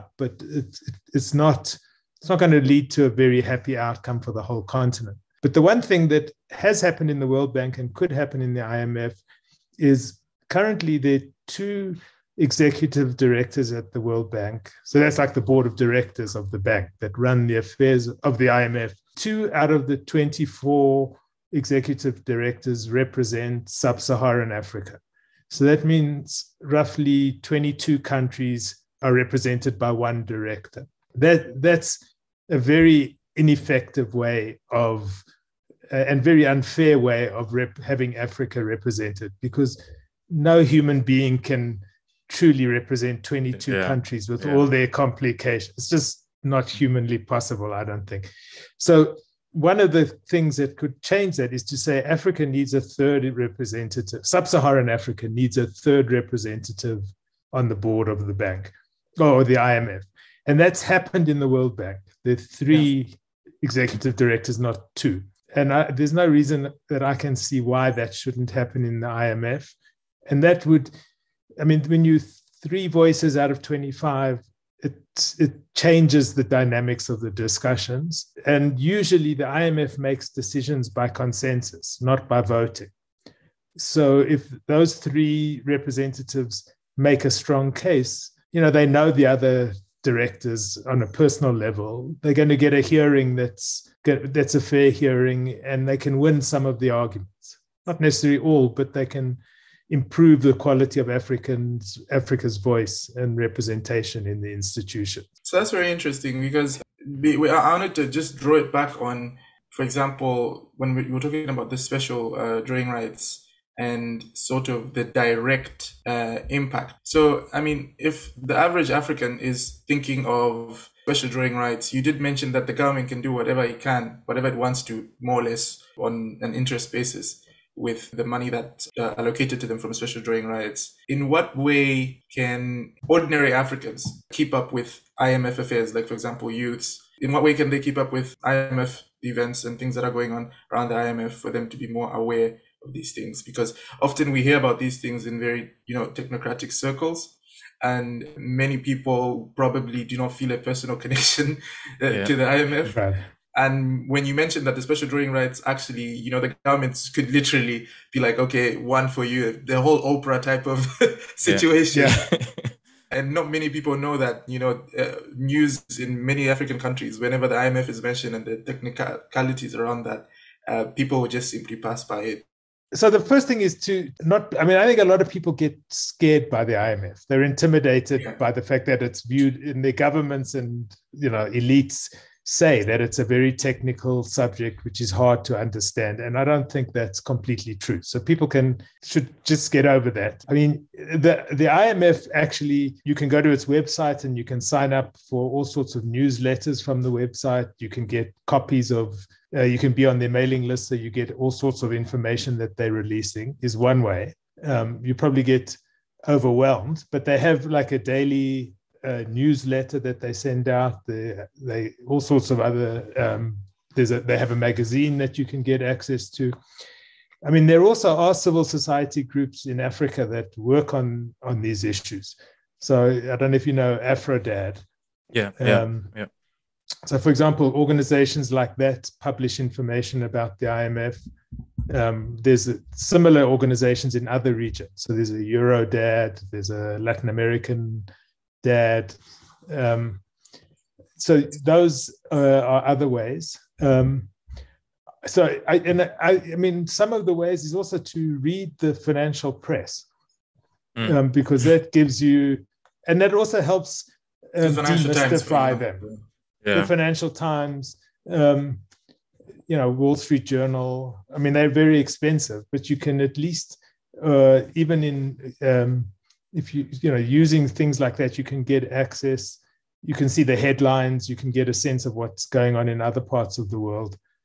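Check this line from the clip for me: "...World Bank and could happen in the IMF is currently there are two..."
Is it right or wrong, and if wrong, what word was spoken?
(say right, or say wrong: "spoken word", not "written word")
right.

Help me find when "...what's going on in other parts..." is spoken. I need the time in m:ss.
4:32.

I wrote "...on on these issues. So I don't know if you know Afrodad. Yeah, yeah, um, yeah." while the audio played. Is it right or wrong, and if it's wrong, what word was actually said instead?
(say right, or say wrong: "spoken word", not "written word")
right.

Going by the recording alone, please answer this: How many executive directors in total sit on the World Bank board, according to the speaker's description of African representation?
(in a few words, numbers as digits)
24.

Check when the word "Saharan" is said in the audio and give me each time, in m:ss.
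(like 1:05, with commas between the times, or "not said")
0:24, 0:54.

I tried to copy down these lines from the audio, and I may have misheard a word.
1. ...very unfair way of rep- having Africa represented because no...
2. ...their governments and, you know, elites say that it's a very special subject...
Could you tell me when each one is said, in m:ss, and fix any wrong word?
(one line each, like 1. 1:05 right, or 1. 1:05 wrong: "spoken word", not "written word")
1. 0:36 right
2. 2:59 wrong: "technical", not "special".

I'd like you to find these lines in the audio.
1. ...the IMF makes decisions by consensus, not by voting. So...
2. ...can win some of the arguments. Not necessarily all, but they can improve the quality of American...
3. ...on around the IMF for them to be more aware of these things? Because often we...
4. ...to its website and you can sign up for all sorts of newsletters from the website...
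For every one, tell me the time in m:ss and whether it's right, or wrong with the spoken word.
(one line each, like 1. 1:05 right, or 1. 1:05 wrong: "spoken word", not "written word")
1. 1:19 right
2. 1:35 wrong: "Africans", not "American"
3. 2:20 right
4. 3:13 right.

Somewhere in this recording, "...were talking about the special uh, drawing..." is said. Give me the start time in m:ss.
1:51.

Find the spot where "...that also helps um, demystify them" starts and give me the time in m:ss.
4:13.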